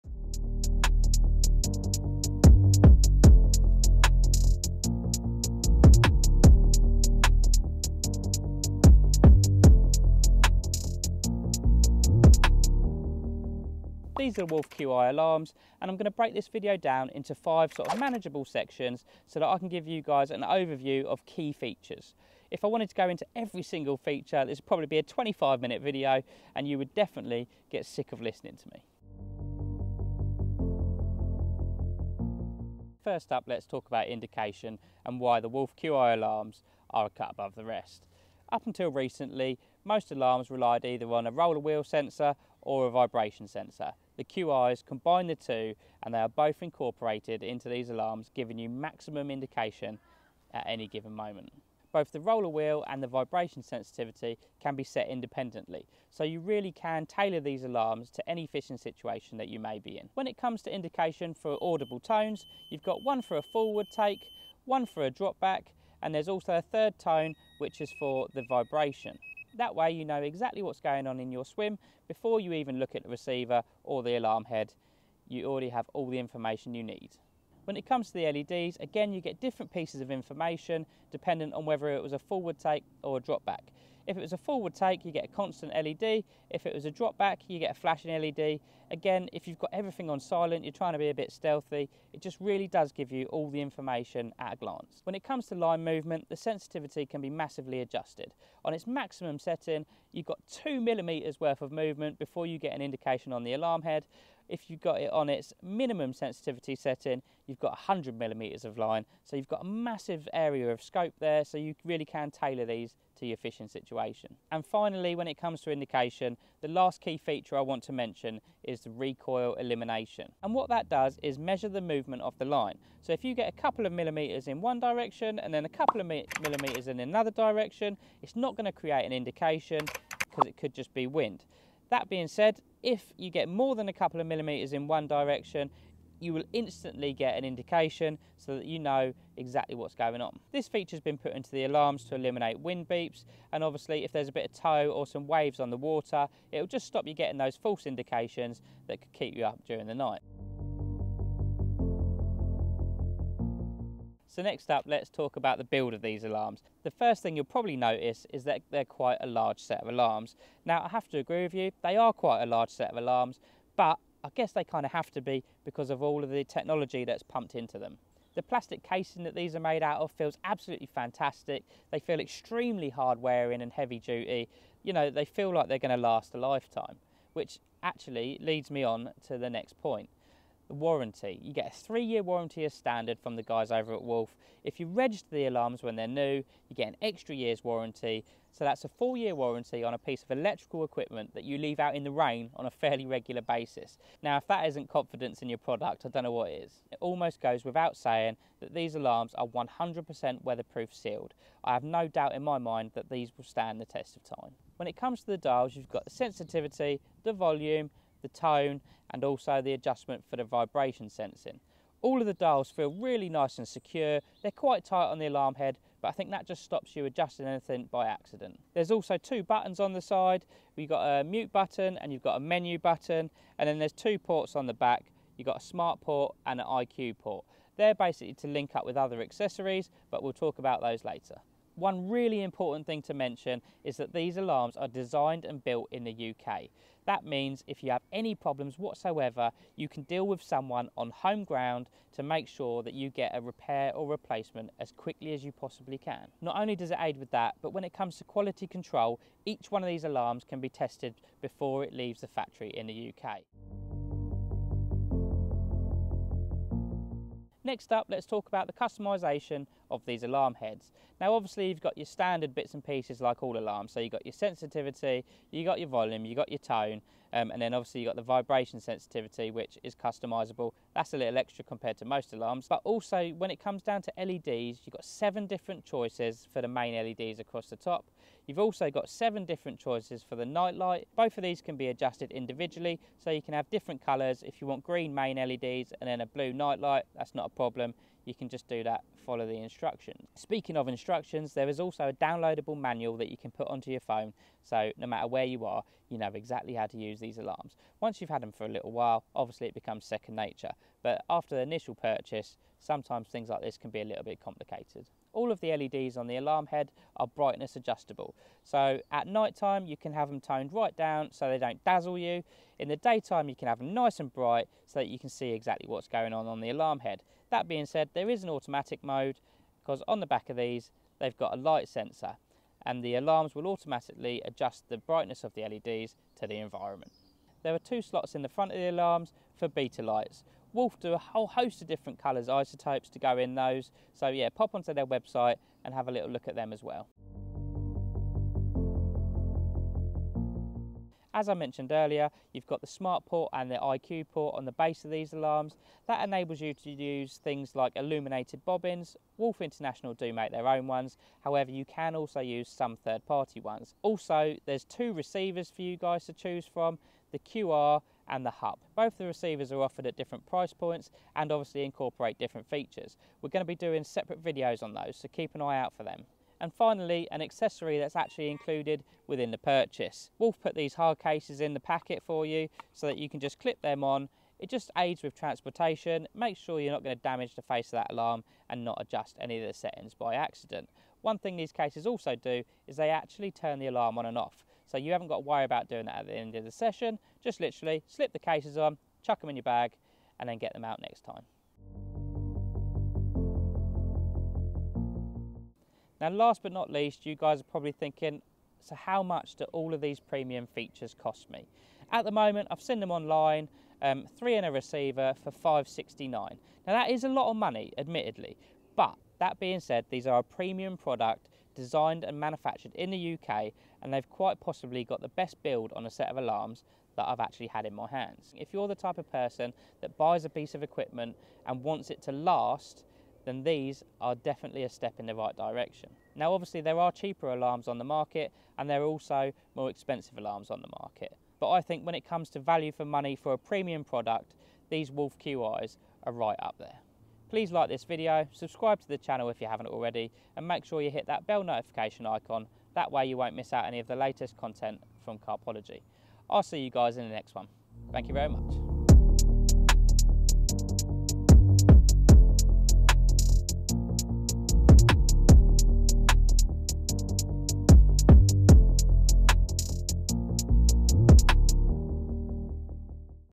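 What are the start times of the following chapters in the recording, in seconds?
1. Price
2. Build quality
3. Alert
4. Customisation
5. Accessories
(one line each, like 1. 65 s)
1. 392 s
2. 150 s
3. 30 s
4. 253 s
5. 337 s.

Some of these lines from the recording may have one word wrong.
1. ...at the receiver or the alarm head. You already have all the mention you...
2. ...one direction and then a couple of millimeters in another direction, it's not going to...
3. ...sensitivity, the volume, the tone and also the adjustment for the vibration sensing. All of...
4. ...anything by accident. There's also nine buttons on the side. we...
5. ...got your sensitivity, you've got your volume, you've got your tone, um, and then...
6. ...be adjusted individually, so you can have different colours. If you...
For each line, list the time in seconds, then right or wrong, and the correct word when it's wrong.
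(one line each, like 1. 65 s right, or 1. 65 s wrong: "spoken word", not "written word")
1. 72 s wrong: "information", not "mention"
2. 124 s right
3. 206 s right
4. 217 s wrong: "two", not "nine"
5. 264 s right
6. 281 s right.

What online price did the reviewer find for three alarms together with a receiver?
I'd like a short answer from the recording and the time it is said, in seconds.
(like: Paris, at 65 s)
569, at 405 s.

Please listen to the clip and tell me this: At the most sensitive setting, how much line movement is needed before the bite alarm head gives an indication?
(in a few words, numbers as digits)
2 millimeters.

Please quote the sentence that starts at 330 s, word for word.
Wolf do a whole host of different colours isotopes to go in those.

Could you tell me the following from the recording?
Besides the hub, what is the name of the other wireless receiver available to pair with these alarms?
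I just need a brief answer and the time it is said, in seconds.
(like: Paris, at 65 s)
QR, at 357 s.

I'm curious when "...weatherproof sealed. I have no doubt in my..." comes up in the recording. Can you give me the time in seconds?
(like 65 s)
200 s.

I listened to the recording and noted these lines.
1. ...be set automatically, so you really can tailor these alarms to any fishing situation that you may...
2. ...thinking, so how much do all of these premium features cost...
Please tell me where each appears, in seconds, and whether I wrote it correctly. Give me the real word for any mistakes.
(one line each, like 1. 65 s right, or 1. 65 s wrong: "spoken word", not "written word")
1. 54 s wrong: "independently", not "automatically"
2. 397 s right.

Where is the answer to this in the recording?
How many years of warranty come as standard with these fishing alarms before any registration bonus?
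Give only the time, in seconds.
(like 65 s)
181 s.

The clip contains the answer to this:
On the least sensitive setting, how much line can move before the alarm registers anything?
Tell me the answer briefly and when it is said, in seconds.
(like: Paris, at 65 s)
100 millimeters, at 107 s.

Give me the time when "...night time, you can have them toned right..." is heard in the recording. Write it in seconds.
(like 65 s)
309 s.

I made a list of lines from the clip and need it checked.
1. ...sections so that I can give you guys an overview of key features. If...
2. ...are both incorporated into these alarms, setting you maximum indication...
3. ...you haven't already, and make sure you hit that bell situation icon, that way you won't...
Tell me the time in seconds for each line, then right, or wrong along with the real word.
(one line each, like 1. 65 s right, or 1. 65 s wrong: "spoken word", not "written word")
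1. 18 s right
2. 46 s wrong: "giving", not "setting"
3. 439 s wrong: "notification", not "situation".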